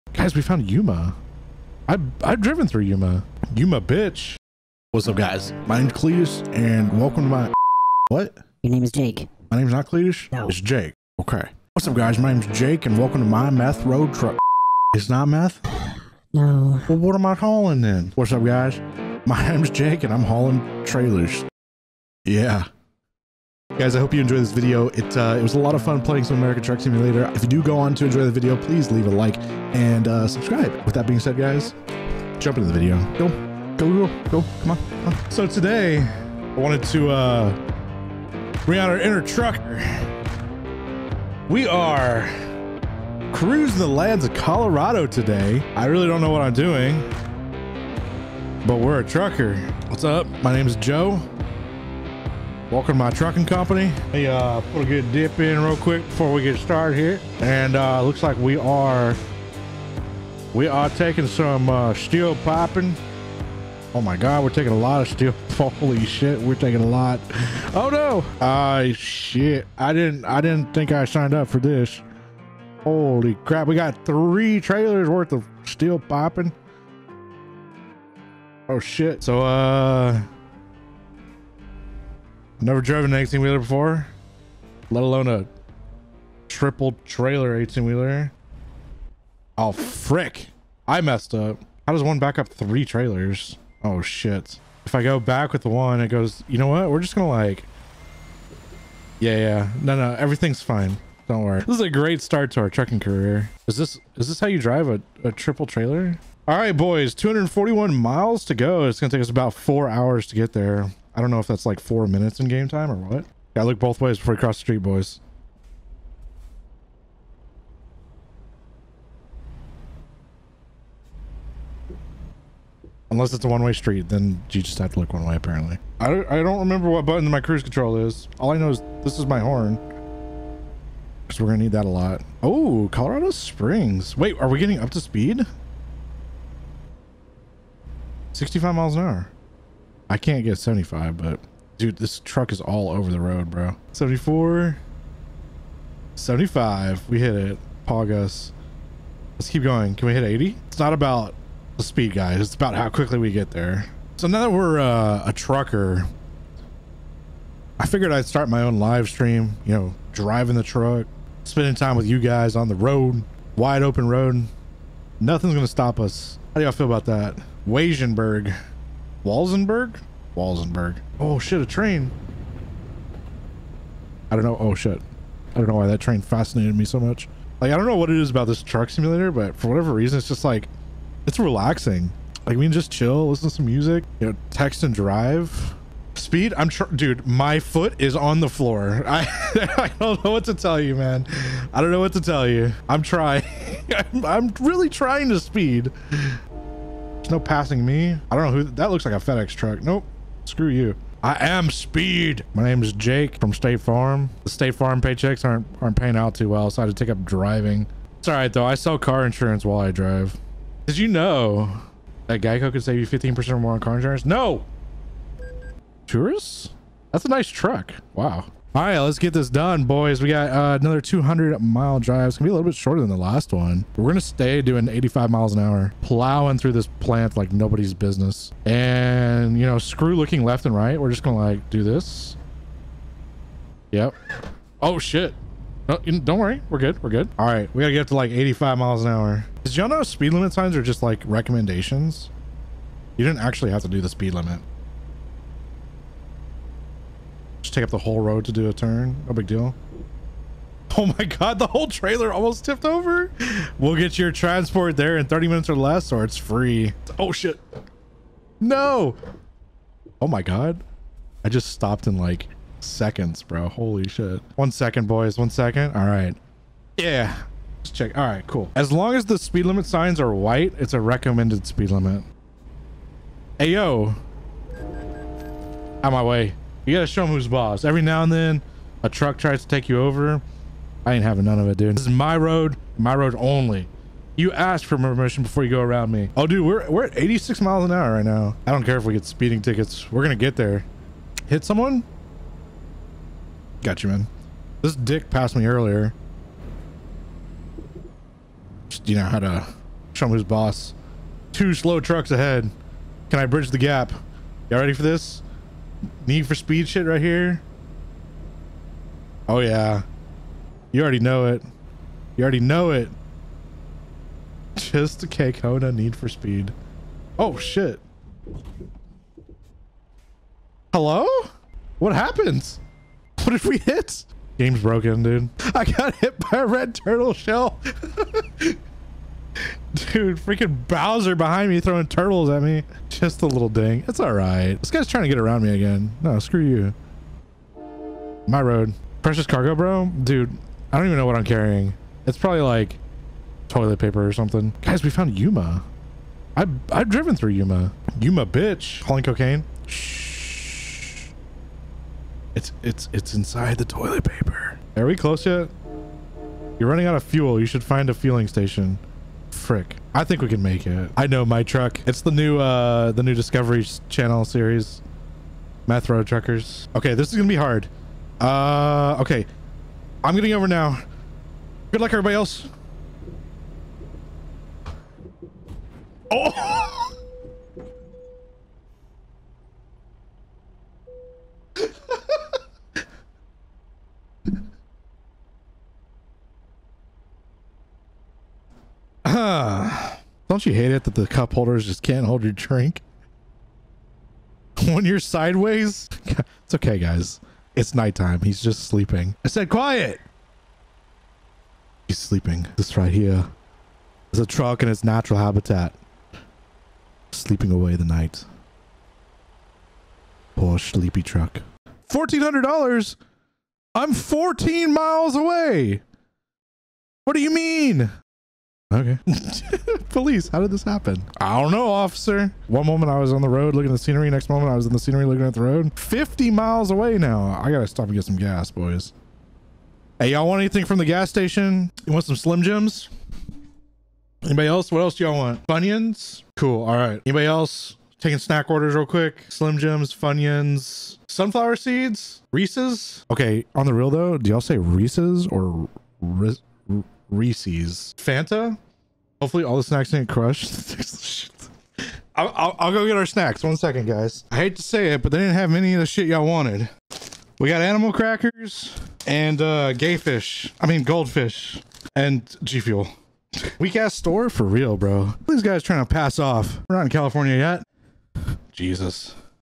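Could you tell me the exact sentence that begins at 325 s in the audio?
I got hit by a red turtle shell.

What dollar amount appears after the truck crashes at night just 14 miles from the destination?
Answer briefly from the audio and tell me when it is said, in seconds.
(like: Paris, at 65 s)
$1,400, at 412 s.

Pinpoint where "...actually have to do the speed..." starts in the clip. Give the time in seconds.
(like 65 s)
243 s.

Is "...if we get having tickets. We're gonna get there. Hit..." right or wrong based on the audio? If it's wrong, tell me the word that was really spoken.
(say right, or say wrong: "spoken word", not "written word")
wrong: "speeding", not "having".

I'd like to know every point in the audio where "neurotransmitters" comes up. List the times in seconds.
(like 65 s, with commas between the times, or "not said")
not said.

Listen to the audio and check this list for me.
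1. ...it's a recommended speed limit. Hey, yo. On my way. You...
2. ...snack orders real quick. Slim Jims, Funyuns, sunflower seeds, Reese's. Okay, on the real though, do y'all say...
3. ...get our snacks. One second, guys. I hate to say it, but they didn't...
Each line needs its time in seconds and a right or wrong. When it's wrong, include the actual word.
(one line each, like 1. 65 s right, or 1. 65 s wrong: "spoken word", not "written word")
1. 270 s right
2. 438 s right
3. 453 s right.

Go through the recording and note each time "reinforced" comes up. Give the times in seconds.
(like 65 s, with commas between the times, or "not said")
not said.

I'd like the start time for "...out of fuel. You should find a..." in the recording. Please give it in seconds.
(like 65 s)
357 s.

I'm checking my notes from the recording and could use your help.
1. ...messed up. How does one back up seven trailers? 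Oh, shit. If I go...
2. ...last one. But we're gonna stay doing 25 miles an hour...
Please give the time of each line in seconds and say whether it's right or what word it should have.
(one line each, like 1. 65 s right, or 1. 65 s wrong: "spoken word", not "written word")
1. 91 s wrong: "three", not "seven"
2. 223 s wrong: "85", not "25".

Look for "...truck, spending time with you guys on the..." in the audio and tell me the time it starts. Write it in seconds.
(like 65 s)
160 s.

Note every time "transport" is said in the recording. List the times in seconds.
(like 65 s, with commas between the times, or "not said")
254 s.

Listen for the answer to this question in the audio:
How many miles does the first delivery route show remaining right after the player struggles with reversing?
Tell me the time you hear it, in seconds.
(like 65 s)
107 s.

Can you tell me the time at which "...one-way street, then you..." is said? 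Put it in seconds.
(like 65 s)
123 s.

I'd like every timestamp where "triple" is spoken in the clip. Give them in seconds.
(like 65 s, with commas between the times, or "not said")
86 s, 105 s.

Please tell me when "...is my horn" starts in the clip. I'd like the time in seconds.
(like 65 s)
129 s.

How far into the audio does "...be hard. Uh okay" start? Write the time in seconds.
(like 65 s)
367 s.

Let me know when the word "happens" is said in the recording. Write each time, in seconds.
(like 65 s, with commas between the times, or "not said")
322 s, 420 s.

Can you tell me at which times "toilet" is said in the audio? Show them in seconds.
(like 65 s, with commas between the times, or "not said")
343 s, 353 s.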